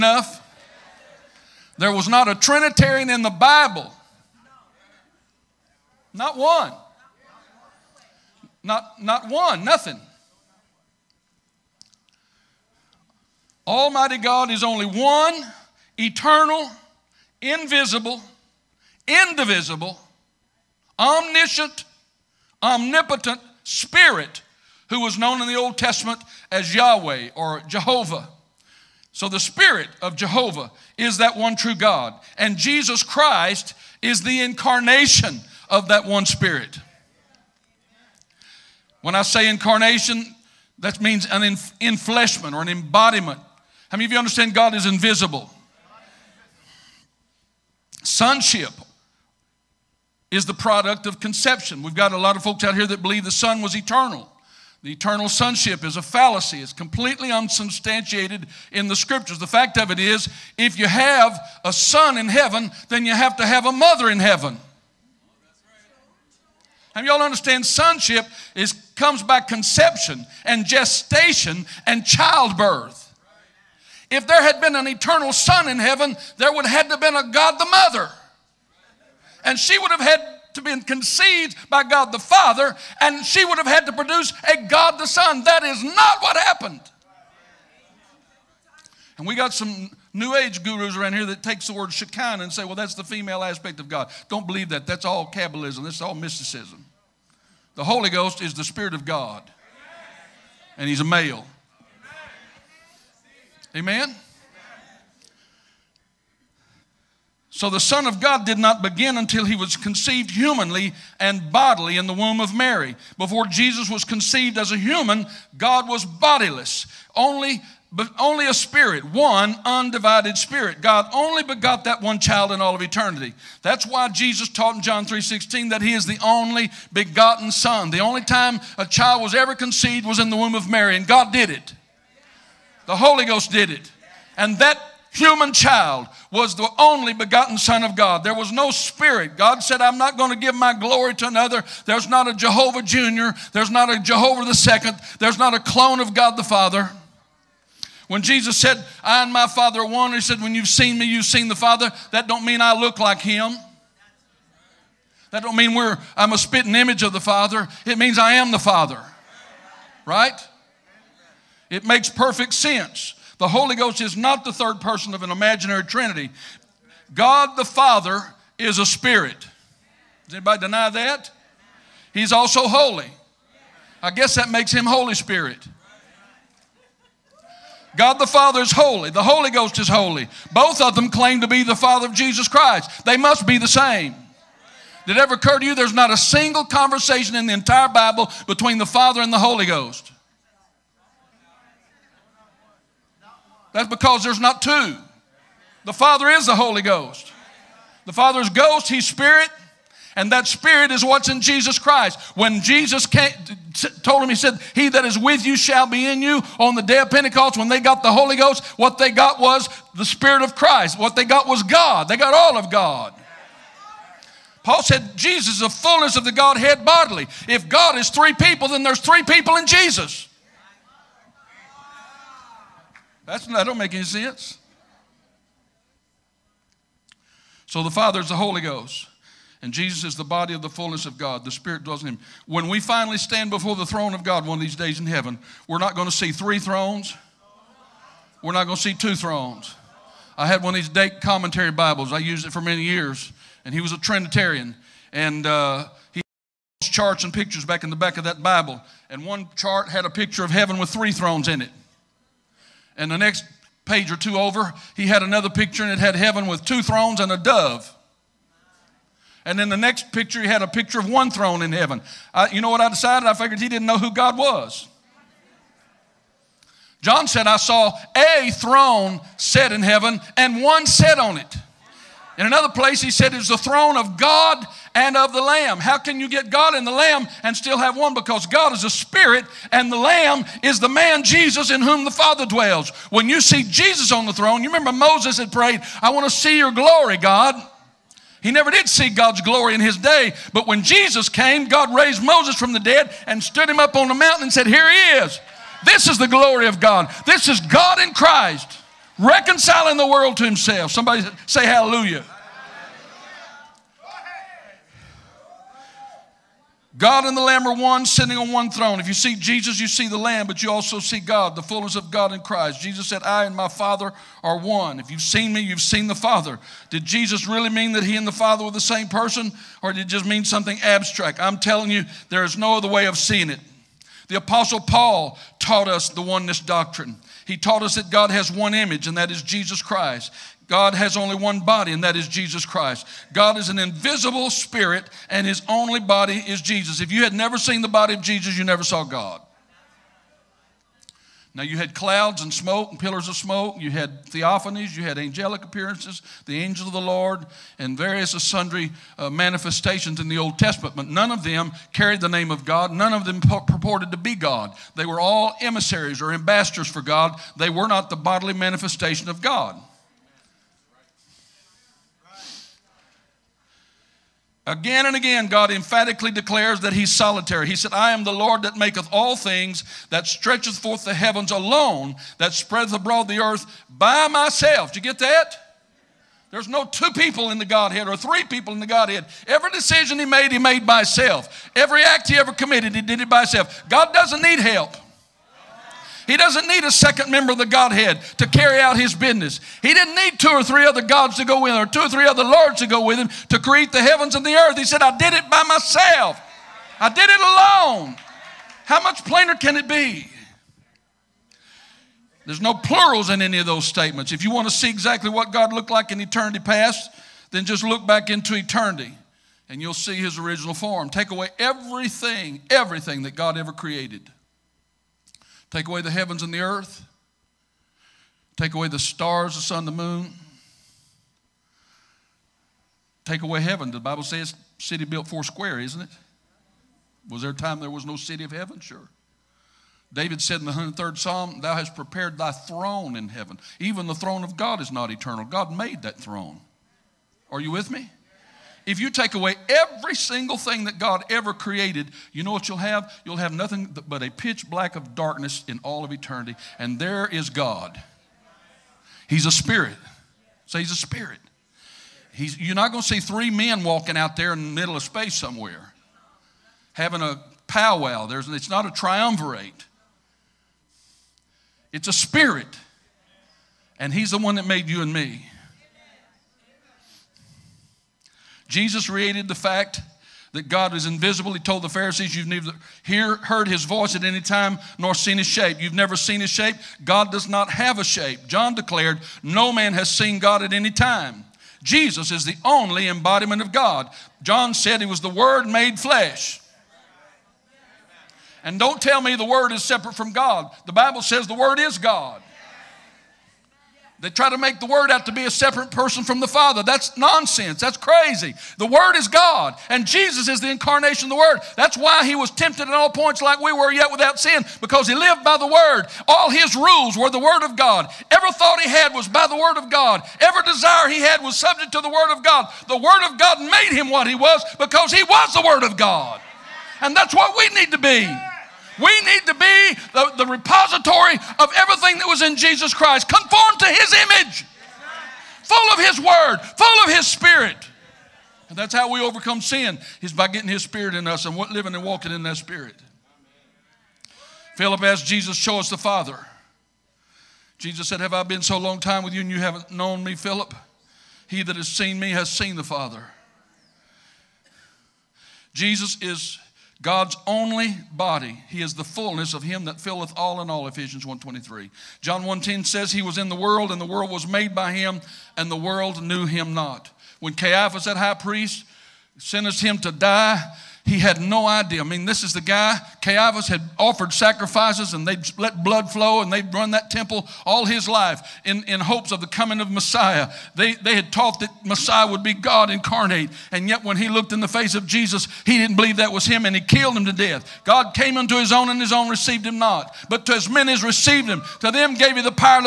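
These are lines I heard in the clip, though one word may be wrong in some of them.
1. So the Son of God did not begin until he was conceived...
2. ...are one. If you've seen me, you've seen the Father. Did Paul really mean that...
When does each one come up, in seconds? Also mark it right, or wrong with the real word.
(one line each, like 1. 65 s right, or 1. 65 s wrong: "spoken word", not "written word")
1. 107 s right
2. 314 s wrong: "Jesus", not "Paul".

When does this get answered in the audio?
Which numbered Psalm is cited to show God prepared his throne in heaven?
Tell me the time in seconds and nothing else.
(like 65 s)
430 s.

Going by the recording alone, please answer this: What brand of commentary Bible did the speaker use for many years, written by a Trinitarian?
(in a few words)
Dake.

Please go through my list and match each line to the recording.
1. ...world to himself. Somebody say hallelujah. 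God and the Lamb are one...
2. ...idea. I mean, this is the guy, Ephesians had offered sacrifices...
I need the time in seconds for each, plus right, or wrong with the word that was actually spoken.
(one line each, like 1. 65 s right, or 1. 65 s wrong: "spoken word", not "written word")
1. 300 s right
2. 561 s wrong: "Caiaphas", not "Ephesians".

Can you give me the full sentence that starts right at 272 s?
In another place, he said, is the throne of God and of the Lamb.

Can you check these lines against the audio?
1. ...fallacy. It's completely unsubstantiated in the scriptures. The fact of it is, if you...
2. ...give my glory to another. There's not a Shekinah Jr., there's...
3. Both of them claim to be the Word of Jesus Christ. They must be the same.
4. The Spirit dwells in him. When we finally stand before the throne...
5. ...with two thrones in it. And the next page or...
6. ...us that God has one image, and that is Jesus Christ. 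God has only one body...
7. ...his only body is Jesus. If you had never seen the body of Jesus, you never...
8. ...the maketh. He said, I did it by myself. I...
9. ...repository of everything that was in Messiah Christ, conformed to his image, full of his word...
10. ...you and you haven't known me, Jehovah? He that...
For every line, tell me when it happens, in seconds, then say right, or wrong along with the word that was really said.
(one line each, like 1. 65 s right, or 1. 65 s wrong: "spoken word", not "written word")
1. 56 s right
2. 140 s wrong: "Jehovah", not "Shekinah"
3. 180 s wrong: "Father", not "Word"
4. 231 s right
5. 250 s wrong: "three", not "two"
6. 327 s right
7. 335 s right
8. 394 s wrong: "earth", not "maketh"
9. 520 s wrong: "Jesus", not "Messiah"
10. 539 s wrong: "Philip", not "Jehovah".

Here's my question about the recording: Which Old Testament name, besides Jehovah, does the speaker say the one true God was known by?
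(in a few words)
Yahweh.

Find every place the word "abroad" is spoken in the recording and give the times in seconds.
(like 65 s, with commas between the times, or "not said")
372 s.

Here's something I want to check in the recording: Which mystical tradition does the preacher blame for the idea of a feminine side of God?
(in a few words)
Kabbalism.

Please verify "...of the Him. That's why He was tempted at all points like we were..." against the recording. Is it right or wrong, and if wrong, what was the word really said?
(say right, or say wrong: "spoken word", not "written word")
wrong: "Word", not "Him".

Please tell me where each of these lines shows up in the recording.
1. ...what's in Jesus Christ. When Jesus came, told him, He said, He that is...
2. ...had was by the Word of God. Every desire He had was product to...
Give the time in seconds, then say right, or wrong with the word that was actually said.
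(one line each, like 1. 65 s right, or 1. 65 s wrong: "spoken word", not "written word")
1. 201 s right
2. 508 s wrong: "subject", not "product".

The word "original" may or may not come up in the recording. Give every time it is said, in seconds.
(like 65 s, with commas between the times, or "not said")
410 s.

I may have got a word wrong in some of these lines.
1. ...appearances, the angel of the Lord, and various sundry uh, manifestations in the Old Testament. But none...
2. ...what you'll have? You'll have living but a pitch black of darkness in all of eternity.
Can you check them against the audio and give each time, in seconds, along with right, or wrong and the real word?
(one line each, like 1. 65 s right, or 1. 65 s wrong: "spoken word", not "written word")
1. 345 s right
2. 442 s wrong: "nothing", not "living".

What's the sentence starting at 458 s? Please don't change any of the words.
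There's, it's not a triumvirate, it's a spirit.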